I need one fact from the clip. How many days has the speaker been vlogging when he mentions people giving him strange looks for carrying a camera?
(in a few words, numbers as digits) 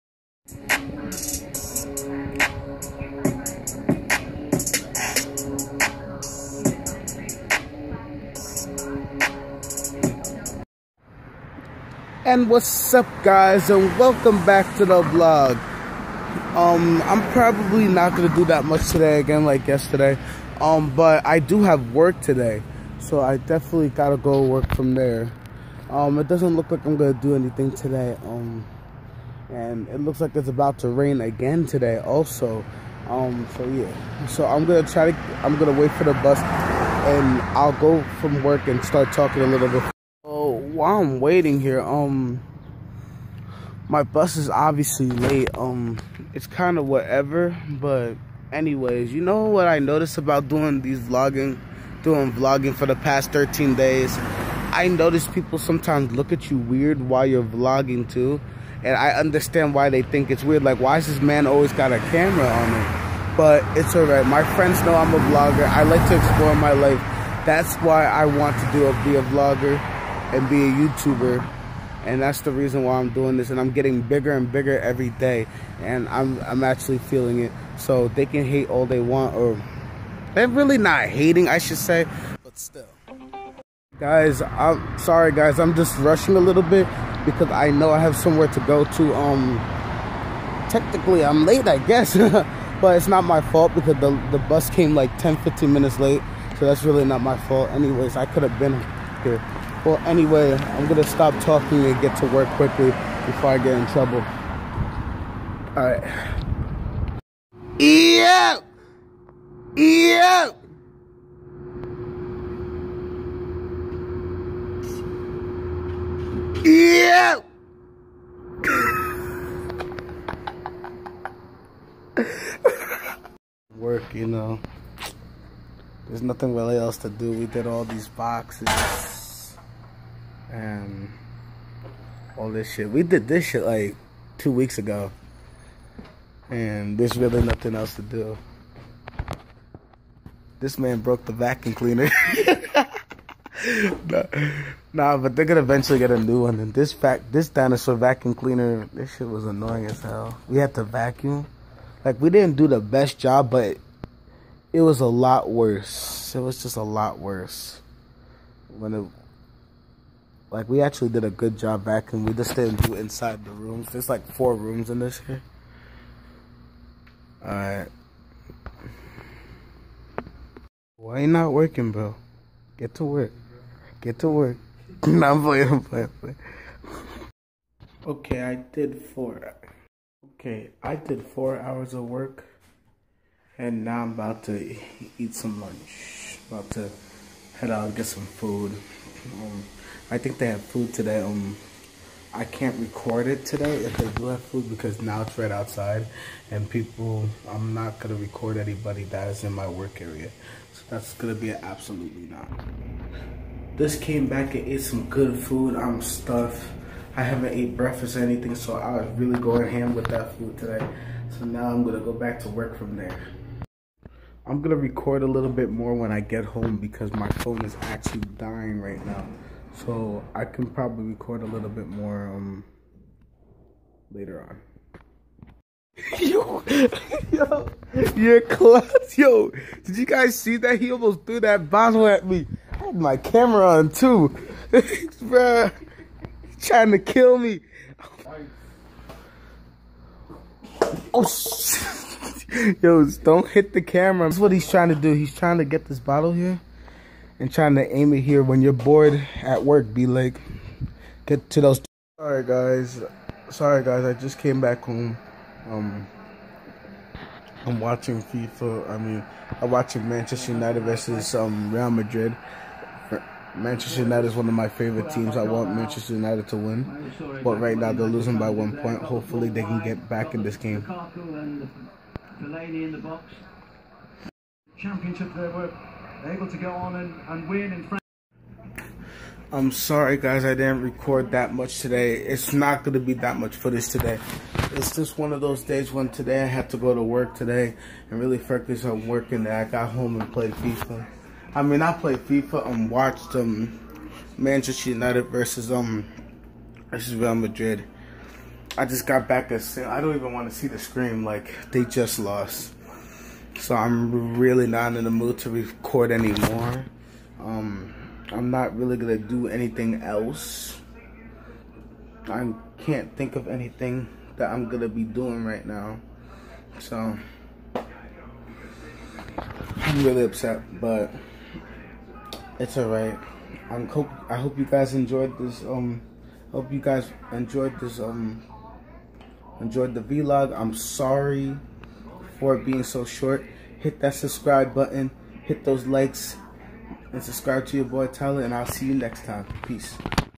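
13.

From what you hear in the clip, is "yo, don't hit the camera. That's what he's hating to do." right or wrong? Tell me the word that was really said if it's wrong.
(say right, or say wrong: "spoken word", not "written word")
wrong: "trying", not "hating".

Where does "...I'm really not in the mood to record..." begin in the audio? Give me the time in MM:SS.
05:03.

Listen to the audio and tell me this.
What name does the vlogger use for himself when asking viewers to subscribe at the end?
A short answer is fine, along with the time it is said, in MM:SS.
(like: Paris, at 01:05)
Tyler, at 05:38.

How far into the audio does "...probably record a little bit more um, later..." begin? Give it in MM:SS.
03:40.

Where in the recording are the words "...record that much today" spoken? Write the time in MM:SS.
04:40.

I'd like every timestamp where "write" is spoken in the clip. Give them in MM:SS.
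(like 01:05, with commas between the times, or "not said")
not said.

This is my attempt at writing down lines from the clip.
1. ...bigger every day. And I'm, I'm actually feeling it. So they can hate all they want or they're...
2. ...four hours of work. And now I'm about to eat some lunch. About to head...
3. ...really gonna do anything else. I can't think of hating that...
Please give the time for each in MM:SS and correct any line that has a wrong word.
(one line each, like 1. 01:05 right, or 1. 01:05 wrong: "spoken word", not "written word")
1. 01:14 right
2. 03:01 right
3. 05:08 wrong: "anything", not "hating".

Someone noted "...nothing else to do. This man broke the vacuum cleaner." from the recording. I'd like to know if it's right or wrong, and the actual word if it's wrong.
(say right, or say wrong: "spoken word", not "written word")
right.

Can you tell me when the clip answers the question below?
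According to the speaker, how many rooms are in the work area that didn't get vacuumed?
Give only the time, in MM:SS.
02:44.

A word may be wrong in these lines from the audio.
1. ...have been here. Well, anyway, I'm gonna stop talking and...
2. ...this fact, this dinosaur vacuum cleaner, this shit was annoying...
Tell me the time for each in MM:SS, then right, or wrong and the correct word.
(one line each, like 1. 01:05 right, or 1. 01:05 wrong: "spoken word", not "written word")
1. 01:38 right
2. 02:26 right.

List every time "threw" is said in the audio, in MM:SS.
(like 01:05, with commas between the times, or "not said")
03:51.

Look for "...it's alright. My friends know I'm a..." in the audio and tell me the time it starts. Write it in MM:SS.
01:03.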